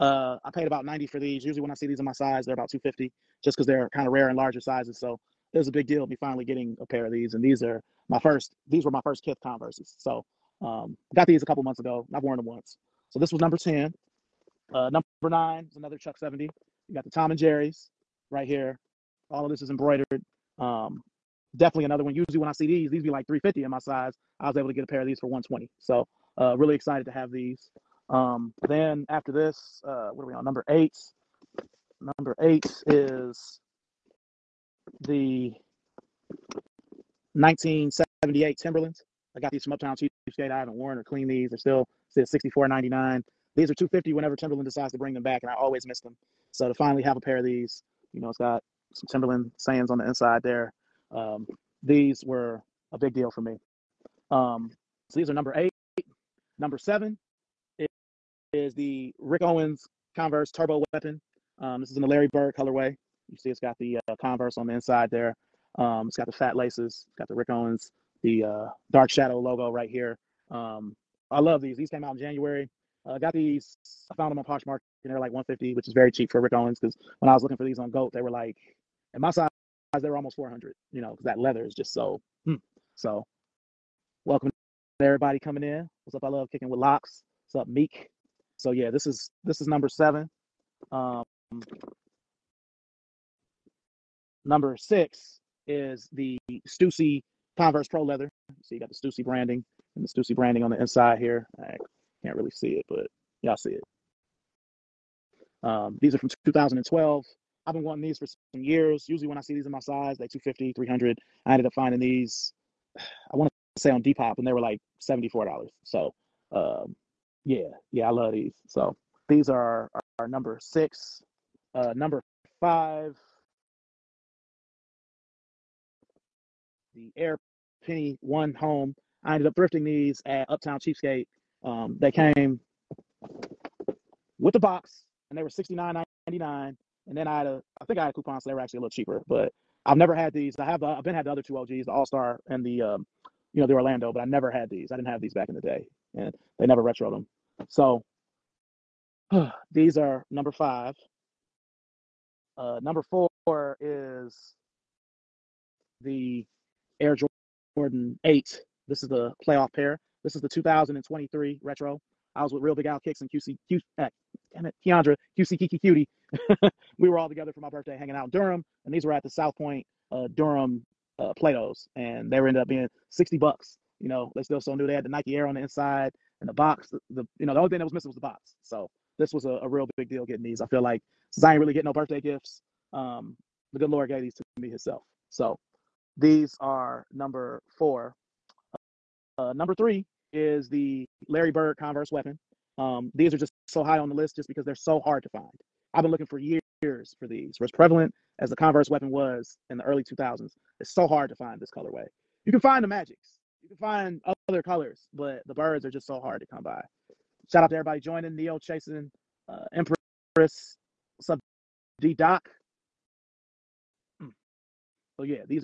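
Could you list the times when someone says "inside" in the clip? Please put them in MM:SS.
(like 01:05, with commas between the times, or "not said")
00:50, 01:04, 01:40, 02:55.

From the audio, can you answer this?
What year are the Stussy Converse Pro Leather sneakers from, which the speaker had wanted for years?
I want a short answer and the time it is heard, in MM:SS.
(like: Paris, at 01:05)
2012, at 01:46.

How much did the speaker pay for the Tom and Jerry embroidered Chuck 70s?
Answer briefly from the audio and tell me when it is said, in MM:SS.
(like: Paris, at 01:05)
$120, at 00:25.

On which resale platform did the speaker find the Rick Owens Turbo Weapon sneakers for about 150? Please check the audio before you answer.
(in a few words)
Poshmark.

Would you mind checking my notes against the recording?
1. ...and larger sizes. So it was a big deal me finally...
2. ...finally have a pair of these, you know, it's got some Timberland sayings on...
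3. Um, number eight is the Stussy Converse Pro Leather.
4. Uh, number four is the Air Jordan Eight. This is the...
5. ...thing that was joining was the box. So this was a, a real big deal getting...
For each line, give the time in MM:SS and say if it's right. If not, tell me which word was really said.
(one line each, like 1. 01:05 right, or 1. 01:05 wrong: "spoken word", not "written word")
1. 00:04 right
2. 00:46 right
3. 01:30 wrong: "six", not "eight"
4. 02:32 right
5. 02:57 wrong: "missing", not "joining".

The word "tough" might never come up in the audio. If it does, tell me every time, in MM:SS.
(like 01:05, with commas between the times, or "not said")
not said.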